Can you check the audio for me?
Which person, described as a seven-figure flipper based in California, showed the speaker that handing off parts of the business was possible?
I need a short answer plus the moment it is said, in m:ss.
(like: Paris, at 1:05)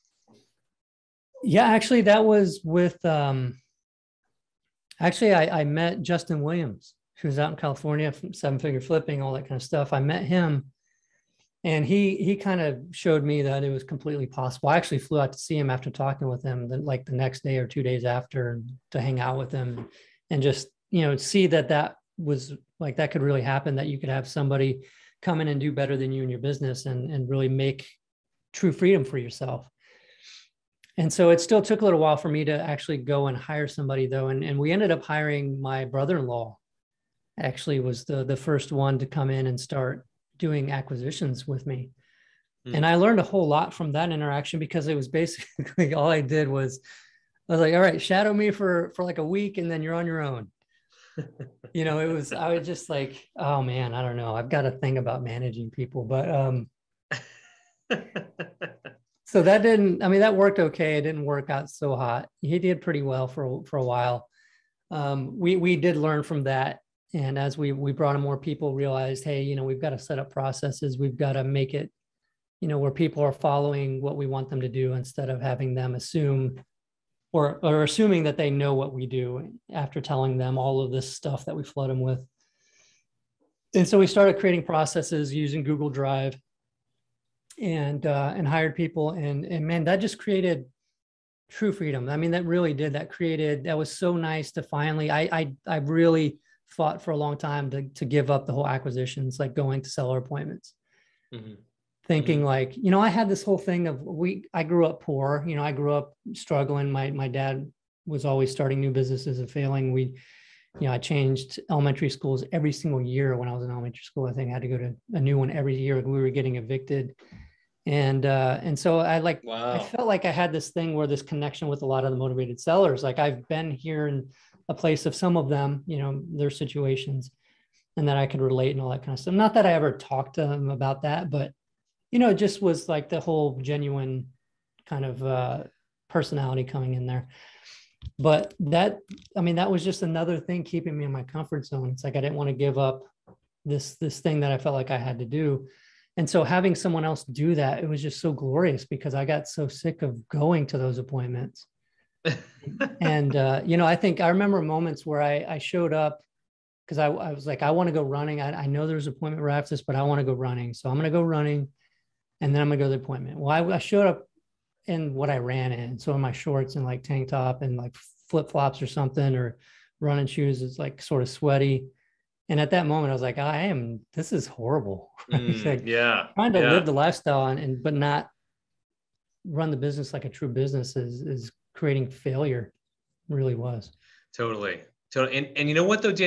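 Justin Williams, at 0:06.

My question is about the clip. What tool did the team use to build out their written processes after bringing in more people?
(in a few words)
Google Drive.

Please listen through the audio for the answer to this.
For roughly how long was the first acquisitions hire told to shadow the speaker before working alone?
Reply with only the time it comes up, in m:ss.
0:49.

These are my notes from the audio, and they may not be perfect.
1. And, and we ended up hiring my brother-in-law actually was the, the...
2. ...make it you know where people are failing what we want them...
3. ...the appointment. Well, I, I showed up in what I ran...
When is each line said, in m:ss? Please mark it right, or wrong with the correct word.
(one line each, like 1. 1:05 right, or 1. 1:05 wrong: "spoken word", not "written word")
1. 0:34 right
2. 1:11 wrong: "following", not "failing"
3. 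2:42 right.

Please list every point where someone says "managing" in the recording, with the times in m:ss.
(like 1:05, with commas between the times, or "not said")
0:55.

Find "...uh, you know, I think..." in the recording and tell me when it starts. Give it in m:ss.
2:33.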